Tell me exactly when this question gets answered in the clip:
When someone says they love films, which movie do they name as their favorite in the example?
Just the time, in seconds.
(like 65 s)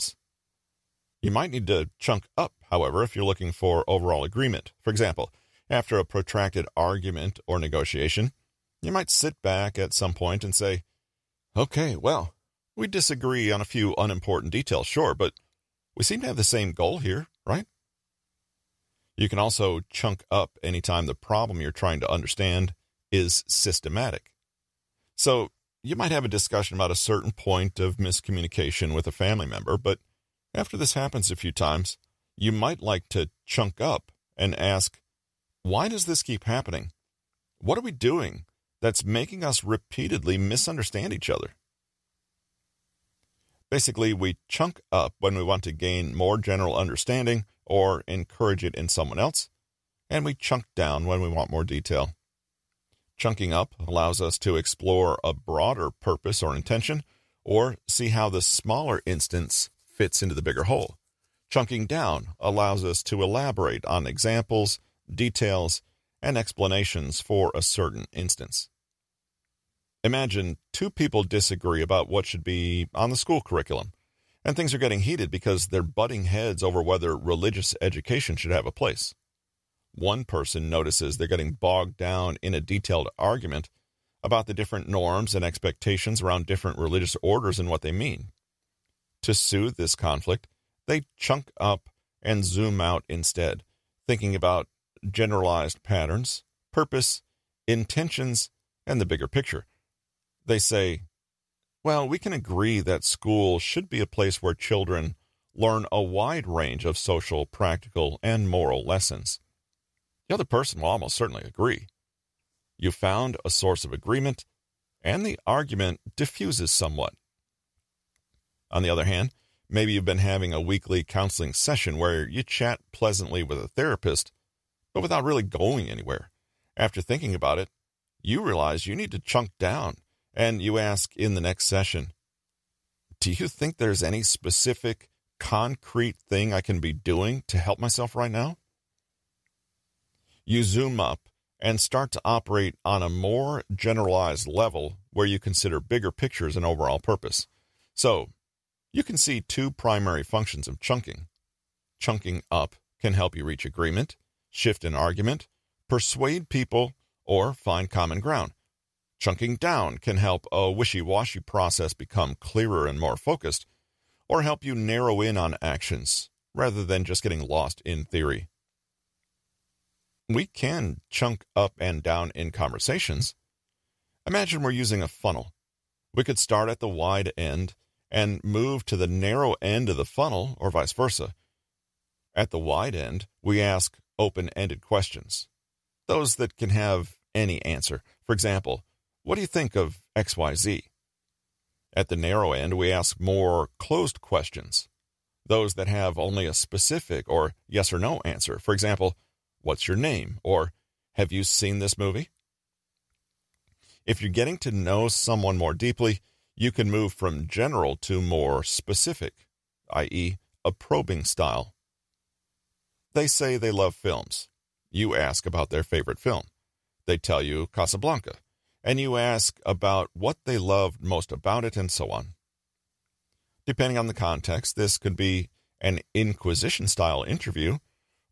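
217 s.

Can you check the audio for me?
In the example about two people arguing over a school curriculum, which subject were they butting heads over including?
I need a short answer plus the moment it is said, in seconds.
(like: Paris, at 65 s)
Religious education, at 77 s.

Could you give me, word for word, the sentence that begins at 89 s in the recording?
To soothe this conflict, they chunk up and zoom out instead, thinking about generalized patterns, purpose, intentions, and the bigger picture.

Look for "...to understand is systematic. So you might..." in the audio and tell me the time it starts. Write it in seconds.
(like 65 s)
22 s.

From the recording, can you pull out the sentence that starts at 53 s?
Chunking up allows us to explore a broader purpose or intention, or see how the smaller instance fits into the bigger whole.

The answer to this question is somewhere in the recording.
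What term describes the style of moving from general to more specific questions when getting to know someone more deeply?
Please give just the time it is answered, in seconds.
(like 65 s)
210 s.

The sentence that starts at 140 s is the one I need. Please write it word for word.
You zoom up and start to operate on a more generalized level where you consider bigger pictures and overall purpose.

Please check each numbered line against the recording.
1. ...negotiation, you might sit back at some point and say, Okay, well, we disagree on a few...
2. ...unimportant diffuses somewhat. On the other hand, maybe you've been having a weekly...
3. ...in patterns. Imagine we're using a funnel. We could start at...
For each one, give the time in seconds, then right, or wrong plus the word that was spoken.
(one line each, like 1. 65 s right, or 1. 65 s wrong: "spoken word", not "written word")
1. 7 s right
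2. 115 s wrong: "argument", not "unimportant"
3. 172 s wrong: "conversations", not "patterns".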